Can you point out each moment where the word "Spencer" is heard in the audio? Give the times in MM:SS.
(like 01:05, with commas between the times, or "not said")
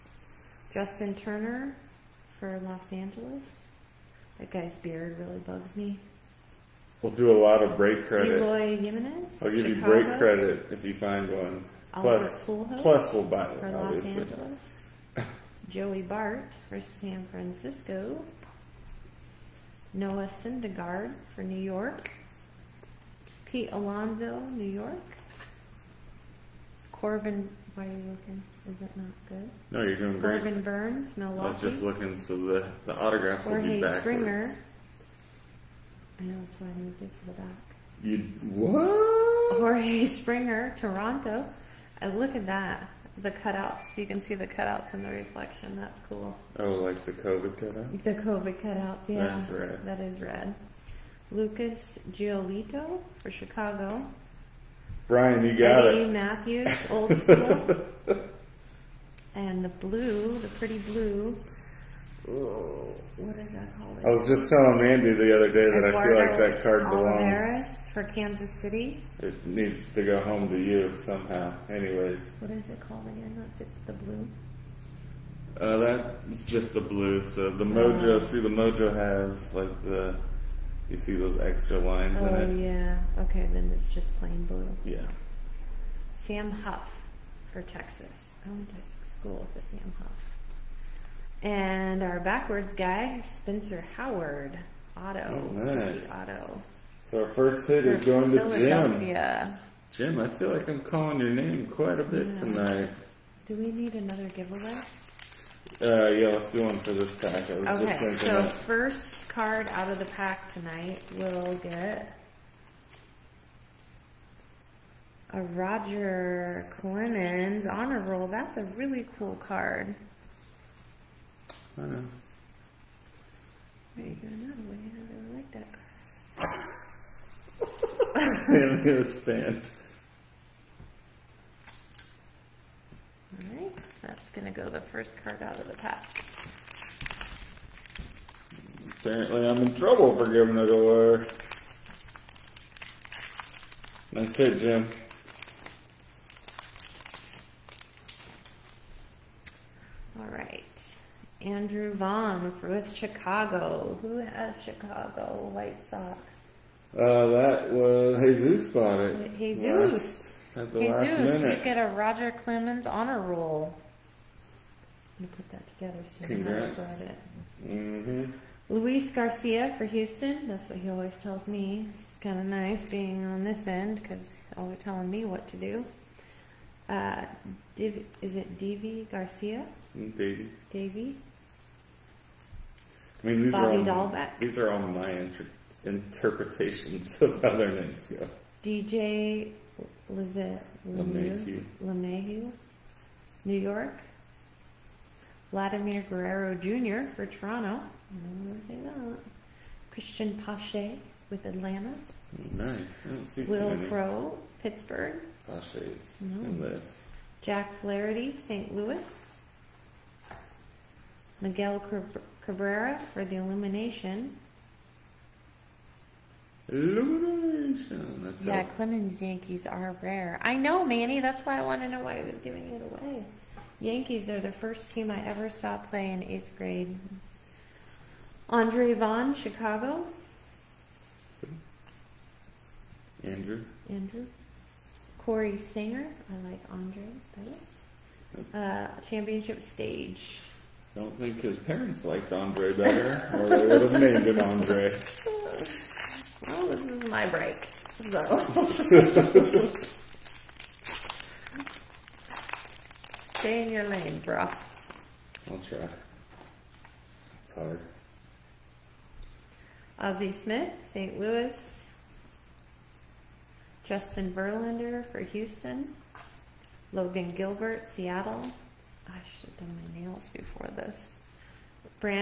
01:33.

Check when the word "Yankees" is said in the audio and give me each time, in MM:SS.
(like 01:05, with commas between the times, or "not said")
03:39, 03:43.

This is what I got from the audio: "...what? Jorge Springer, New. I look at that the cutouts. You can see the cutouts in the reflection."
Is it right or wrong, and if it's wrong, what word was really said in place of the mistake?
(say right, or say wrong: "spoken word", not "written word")
wrong: "Toronto", not "New".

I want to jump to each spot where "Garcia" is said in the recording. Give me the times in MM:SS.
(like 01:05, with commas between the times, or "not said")
02:49, 02:59.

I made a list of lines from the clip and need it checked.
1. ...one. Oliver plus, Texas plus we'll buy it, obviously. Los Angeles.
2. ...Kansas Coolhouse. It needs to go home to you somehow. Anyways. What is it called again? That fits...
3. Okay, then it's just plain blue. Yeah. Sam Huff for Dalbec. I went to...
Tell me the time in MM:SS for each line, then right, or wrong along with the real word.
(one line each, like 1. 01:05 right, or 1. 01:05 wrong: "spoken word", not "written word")
1. 00:11 wrong: "Coolhouse", not "Texas"
2. 01:08 wrong: "City", not "Coolhouse"
3. 01:23 wrong: "Texas", not "Dalbec".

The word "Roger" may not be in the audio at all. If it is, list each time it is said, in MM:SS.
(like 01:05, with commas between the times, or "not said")
01:55, 02:41.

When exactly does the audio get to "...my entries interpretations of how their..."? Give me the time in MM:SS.
03:04.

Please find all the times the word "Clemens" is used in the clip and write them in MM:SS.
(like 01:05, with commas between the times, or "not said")
01:56, 02:42, 03:38.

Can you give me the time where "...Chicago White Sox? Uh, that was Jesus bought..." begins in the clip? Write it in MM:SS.
02:34.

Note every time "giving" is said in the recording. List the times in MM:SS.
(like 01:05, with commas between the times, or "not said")
02:20, 03:42.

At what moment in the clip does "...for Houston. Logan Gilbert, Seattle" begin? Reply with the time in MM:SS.
04:25.